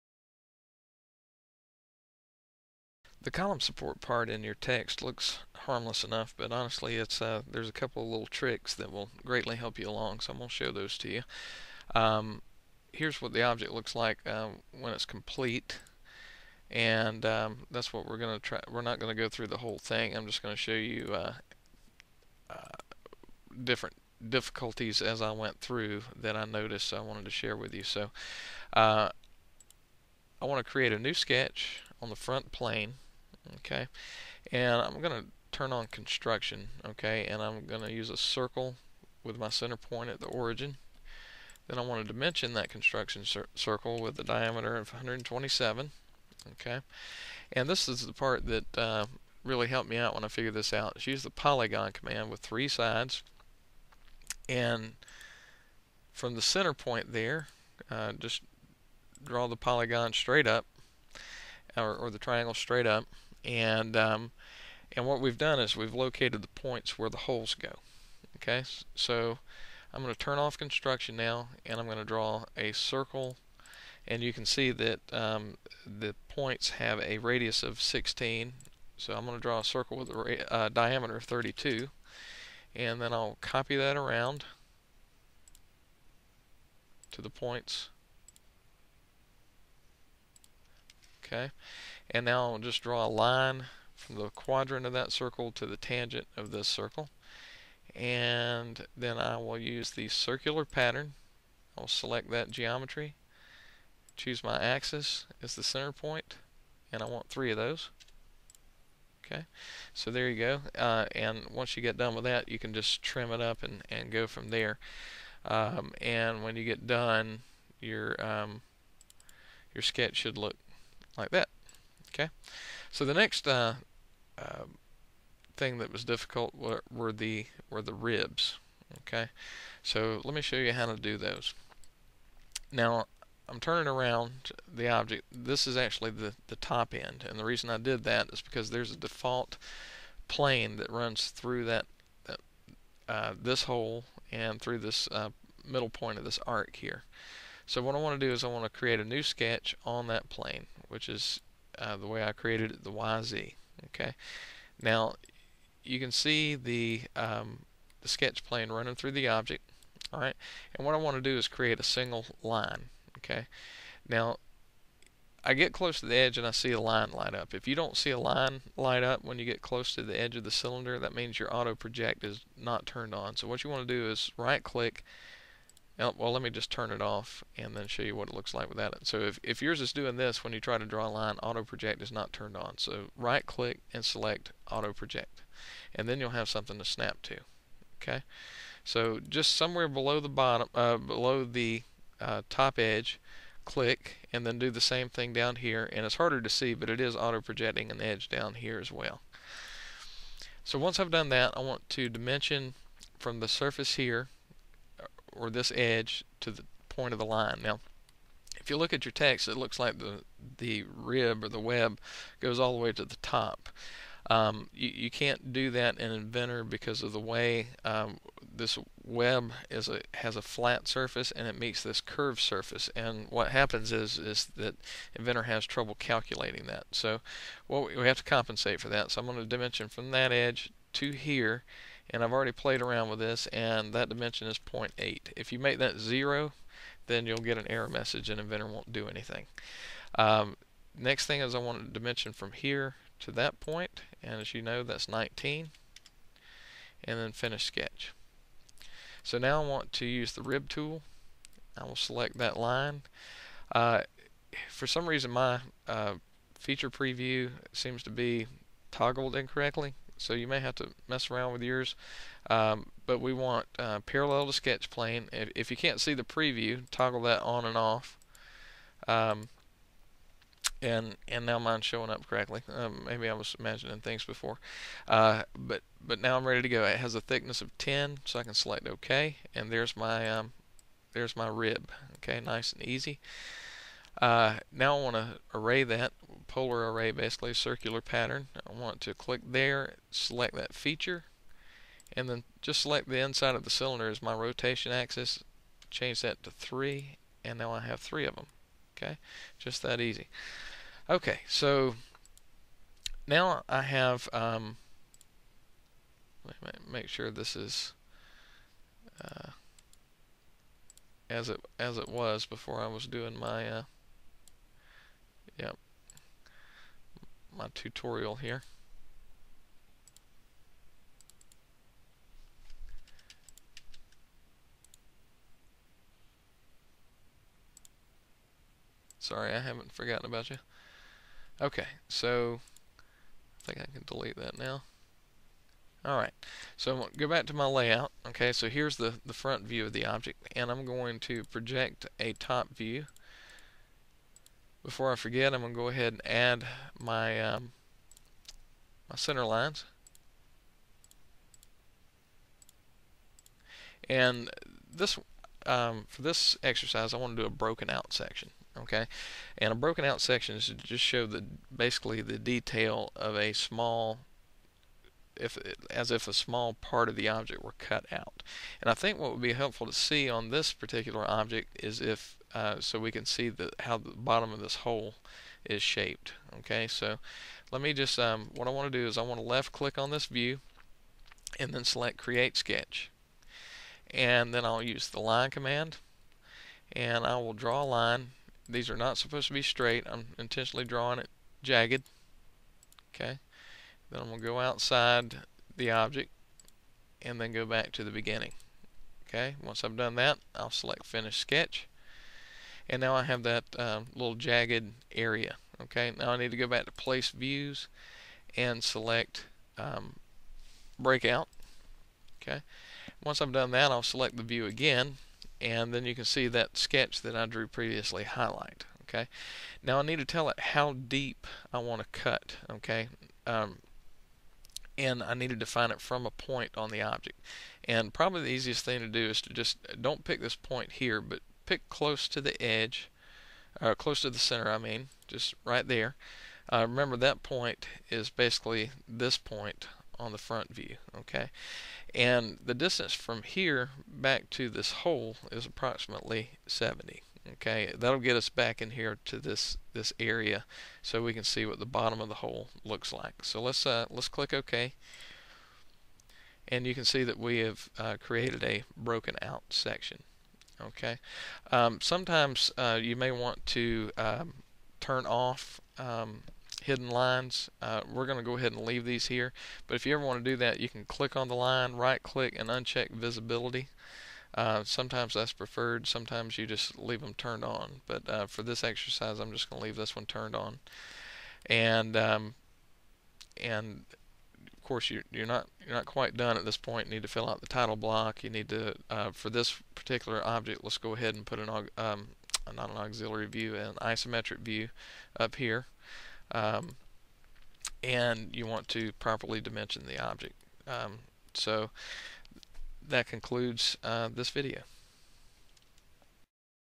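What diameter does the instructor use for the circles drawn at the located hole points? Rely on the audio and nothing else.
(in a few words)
32.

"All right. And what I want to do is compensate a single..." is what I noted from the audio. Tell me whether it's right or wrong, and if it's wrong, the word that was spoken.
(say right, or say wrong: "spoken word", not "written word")
wrong: "create", not "compensate".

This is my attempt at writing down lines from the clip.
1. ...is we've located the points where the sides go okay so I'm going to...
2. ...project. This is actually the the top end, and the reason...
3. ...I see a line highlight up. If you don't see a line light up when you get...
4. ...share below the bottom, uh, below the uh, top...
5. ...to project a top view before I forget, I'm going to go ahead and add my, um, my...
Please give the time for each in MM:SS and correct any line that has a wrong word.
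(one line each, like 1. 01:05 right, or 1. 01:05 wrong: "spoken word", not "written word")
1. 01:05 wrong: "holes", not "sides"
2. 02:14 wrong: "object", not "project"
3. 02:46 wrong: "light", not "highlight"
4. 03:09 wrong: "somewhere", not "share"
5. 05:41 right.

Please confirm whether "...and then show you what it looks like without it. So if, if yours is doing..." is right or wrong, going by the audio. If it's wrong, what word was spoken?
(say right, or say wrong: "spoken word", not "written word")
right.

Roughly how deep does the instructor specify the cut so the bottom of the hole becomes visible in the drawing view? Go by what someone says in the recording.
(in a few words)
70.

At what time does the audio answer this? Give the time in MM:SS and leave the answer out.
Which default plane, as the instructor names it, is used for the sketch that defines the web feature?
02:32.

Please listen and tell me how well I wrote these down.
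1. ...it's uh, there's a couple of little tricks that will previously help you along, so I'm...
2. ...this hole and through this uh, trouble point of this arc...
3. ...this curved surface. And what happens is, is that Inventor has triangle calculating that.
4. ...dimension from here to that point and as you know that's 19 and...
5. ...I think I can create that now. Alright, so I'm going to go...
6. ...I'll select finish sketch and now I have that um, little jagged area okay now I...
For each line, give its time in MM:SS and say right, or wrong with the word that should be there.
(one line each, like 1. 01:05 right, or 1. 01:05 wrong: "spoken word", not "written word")
1. 00:06 wrong: "greatly", not "previously"
2. 02:23 wrong: "middle", not "trouble"
3. 03:41 wrong: "trouble", not "triangle"
4. 04:01 right
5. 05:32 wrong: "delete", not "create"
6. 06:40 right.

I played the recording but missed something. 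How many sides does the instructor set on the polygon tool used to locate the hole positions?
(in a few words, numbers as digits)
3.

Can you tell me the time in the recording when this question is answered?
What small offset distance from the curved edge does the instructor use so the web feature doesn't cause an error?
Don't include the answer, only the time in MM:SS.
03:54.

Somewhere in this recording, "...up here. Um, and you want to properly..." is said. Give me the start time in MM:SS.
08:15.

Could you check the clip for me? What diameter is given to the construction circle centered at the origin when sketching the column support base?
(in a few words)
127.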